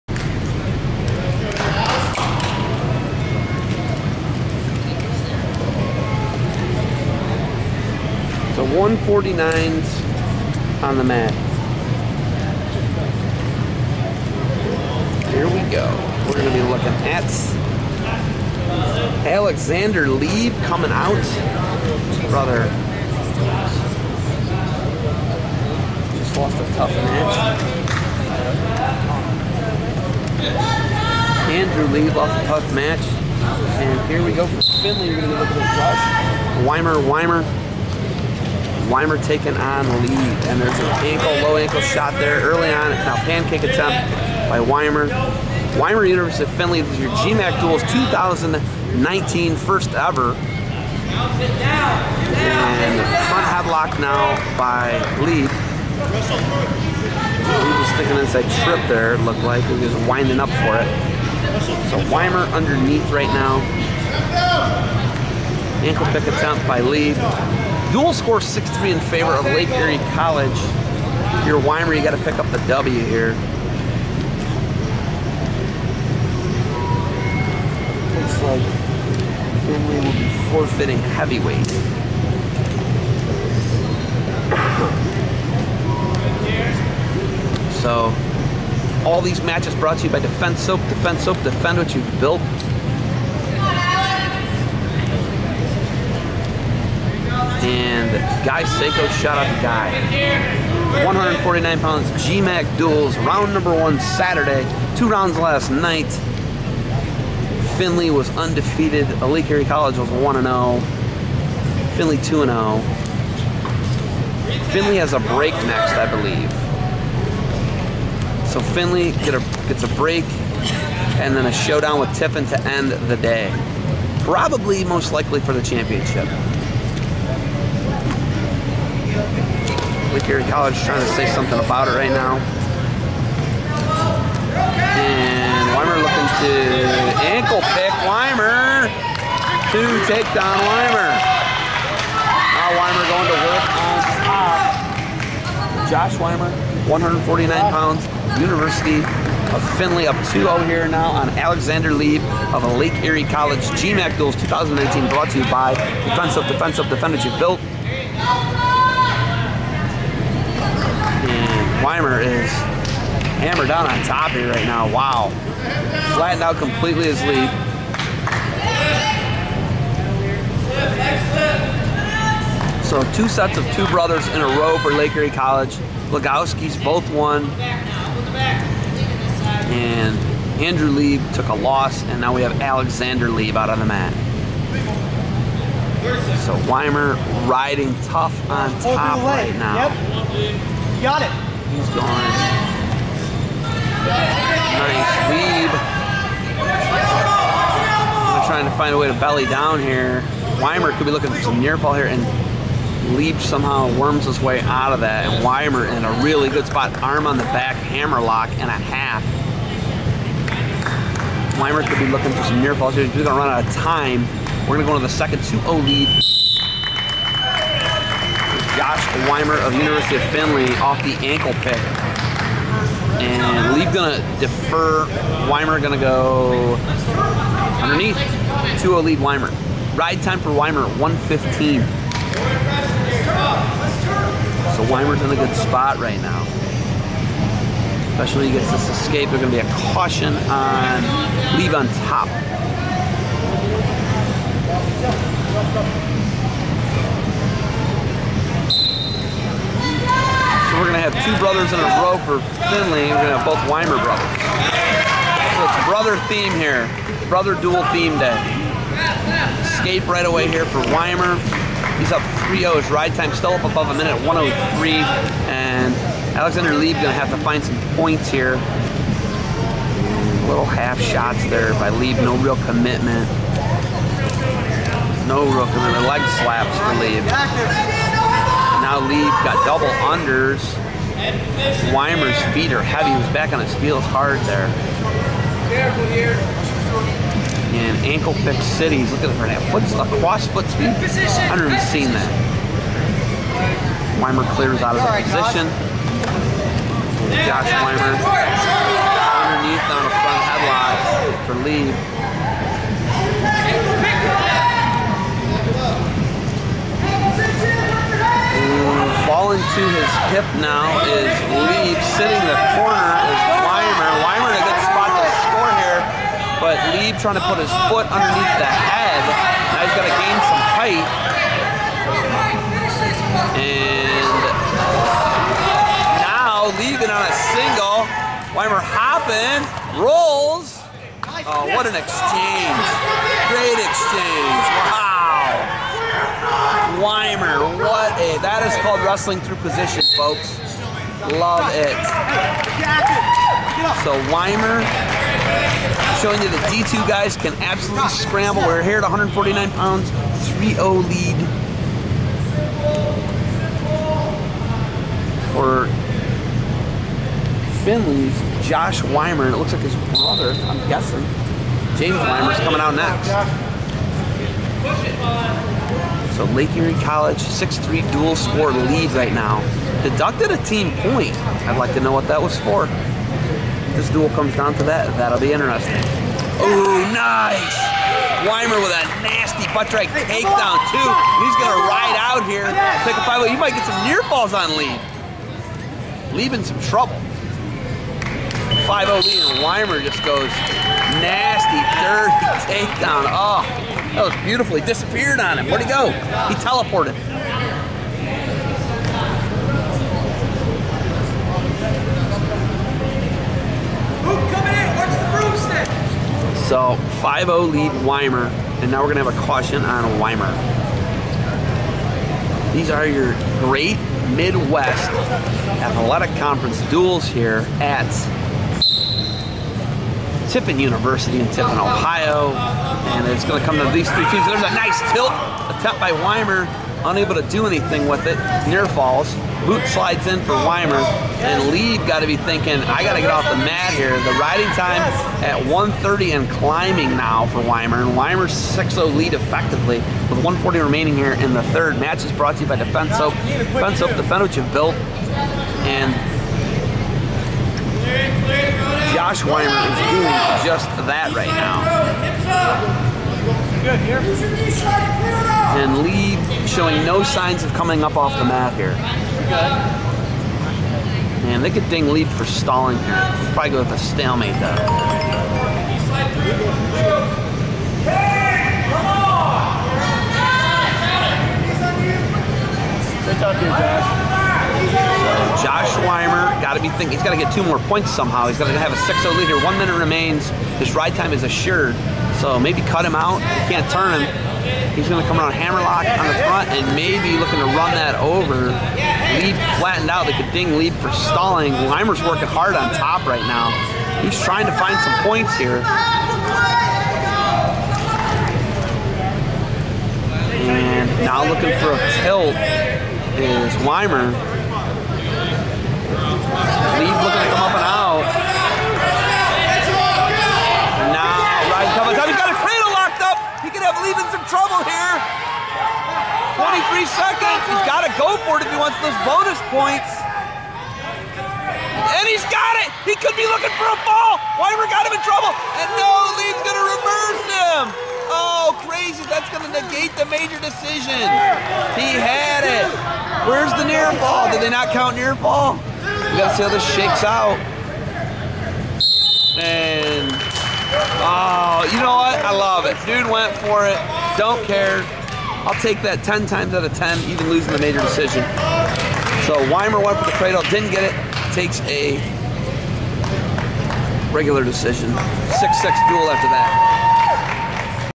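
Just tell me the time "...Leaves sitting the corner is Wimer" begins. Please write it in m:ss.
5:11.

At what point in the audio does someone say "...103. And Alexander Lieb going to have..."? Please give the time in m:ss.
4:24.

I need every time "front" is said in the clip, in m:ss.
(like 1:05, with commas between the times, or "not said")
0:53, 5:00, 8:06.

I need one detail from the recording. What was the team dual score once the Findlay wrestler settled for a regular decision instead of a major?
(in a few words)
6-6.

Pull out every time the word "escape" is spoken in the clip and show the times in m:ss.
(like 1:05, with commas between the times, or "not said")
3:58, 4:19.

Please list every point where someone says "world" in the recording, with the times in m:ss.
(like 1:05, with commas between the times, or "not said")
not said.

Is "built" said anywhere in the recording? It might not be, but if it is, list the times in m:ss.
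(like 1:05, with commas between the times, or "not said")
1:32, 2:37, 7:24.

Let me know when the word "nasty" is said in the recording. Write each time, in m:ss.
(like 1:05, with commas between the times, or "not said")
6:19, 6:31.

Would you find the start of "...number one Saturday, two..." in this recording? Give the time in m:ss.
1:43.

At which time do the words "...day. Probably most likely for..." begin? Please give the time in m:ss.
2:03.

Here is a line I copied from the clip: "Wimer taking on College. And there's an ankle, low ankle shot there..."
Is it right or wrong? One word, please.
wrong.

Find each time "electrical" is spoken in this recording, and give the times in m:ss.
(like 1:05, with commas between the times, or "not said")
not said.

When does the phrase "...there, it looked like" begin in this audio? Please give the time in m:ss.
0:58.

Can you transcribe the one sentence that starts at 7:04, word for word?
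There's a nice tilt, a tap by Wimer, unable to do anything with it.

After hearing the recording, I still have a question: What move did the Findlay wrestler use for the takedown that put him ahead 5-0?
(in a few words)
butt drag.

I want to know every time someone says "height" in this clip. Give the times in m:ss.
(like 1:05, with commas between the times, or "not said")
5:20.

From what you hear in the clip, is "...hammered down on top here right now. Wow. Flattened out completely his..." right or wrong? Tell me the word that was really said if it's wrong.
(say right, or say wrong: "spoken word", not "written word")
right.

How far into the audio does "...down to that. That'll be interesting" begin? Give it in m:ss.
6:14.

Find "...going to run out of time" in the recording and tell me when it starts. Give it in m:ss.
3:33.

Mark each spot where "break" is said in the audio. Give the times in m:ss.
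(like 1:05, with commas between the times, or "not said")
1:55, 1:59.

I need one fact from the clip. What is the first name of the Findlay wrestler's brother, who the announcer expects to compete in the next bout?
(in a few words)
James.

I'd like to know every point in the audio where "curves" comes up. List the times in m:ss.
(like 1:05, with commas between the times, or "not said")
not said.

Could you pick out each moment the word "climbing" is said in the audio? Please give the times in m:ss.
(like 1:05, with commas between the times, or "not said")
7:16.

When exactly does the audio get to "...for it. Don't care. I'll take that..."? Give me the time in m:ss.
9:03.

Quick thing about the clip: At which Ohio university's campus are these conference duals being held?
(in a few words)
Tiffin University.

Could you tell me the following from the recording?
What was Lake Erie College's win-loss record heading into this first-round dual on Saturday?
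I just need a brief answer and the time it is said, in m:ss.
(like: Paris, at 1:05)
1 0, at 1:50.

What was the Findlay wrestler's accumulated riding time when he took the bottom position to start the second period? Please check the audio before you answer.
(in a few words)
1:15.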